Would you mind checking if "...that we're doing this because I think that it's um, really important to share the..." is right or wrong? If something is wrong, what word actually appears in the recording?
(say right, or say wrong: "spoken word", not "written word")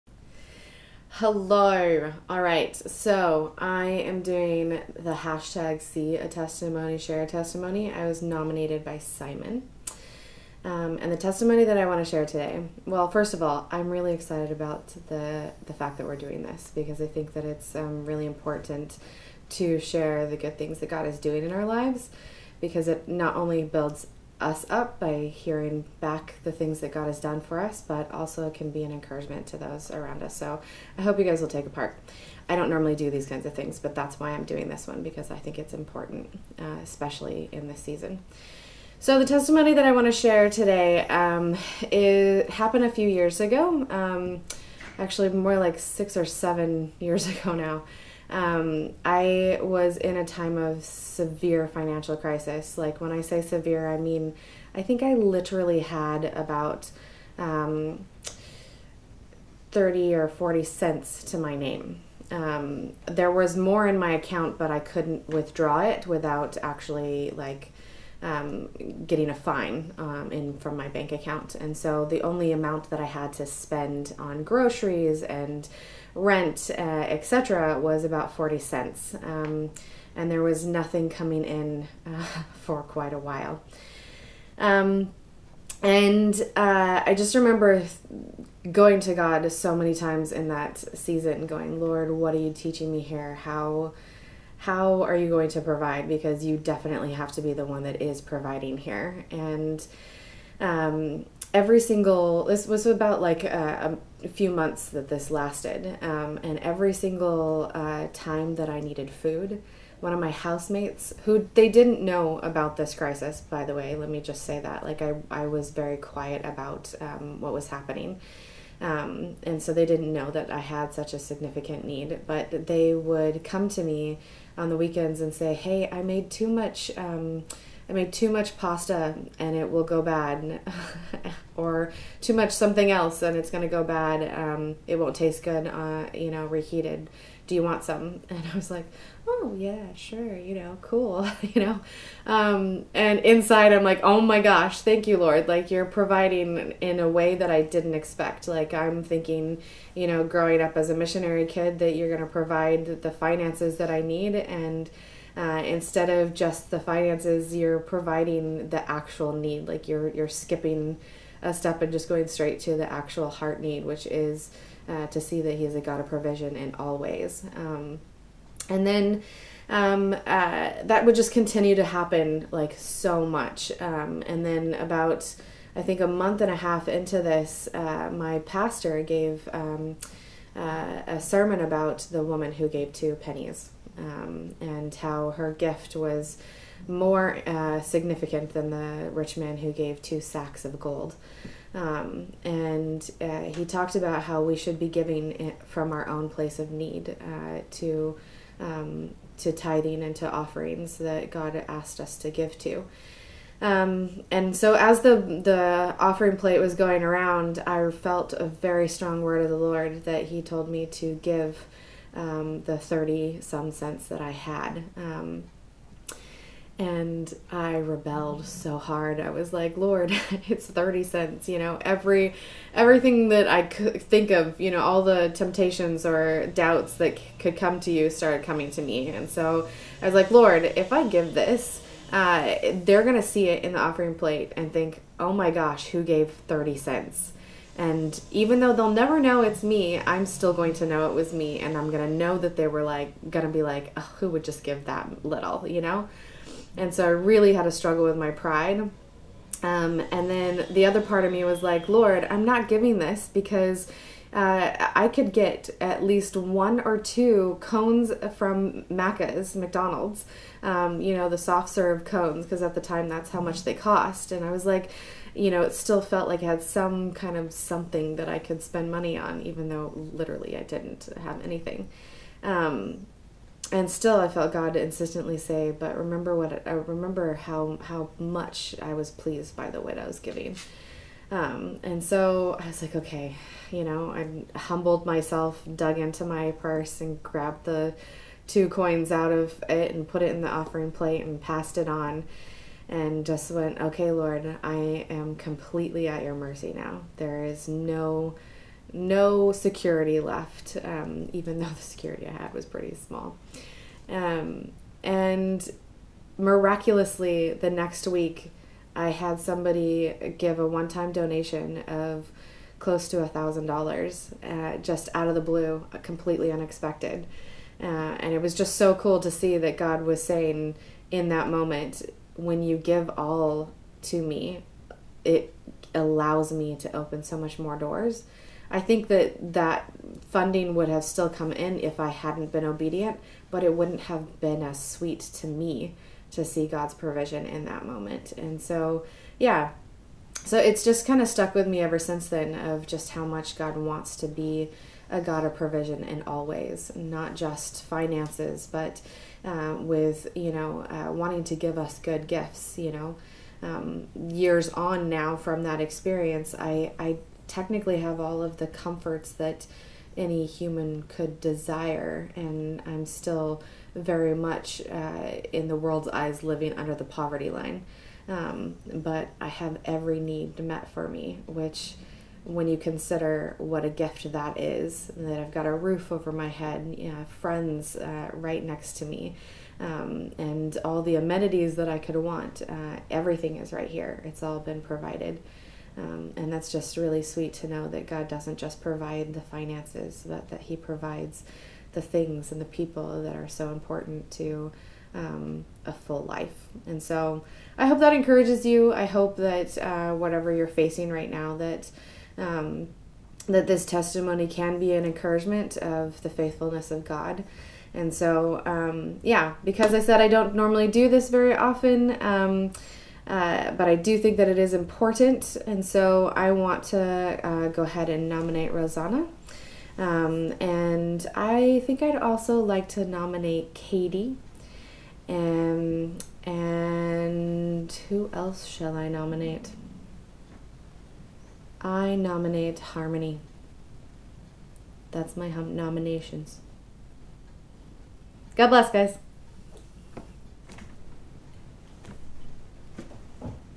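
right.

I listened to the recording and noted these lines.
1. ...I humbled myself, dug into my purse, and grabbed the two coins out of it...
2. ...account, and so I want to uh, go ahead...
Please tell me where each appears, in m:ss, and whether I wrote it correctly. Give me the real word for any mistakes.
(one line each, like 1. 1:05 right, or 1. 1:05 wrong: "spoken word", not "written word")
1. 4:44 right
2. 6:54 wrong: "important", not "account".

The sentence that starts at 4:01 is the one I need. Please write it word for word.
And I'm going to know that they were like, going to be like, oh, who would just give that little, you know?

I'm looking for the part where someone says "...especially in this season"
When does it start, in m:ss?
0:36.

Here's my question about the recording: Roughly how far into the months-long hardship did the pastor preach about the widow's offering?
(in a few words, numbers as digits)
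A month and a half.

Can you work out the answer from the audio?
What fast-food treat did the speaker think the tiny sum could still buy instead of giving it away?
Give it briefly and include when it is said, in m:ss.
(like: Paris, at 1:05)
Soft serve cones, at 4:21.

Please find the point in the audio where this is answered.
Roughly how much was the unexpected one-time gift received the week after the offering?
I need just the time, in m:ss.
5:12.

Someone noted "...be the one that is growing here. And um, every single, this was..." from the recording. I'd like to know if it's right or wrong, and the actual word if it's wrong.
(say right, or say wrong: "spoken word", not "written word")
wrong: "providing", not "growing".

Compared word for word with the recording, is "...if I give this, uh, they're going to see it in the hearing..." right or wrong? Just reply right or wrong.
wrong.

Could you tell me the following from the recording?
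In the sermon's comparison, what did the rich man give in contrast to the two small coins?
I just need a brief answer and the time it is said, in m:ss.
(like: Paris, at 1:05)
Two sacks of gold, at 3:10.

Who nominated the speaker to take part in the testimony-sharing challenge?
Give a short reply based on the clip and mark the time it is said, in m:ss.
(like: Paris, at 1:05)
Simon, at 0:08.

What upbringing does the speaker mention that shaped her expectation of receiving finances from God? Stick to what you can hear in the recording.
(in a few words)
Missionary kid.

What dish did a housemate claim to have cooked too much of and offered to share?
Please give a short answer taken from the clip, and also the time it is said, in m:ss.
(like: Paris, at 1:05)
Pasta, at 2:08.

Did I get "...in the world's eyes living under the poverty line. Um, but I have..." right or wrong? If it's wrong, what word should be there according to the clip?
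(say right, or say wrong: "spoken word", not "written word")
right.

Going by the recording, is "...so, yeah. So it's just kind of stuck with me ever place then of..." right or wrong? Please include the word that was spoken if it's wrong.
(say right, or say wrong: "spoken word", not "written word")
wrong: "since", not "place".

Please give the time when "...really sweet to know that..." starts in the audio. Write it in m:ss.
6:26.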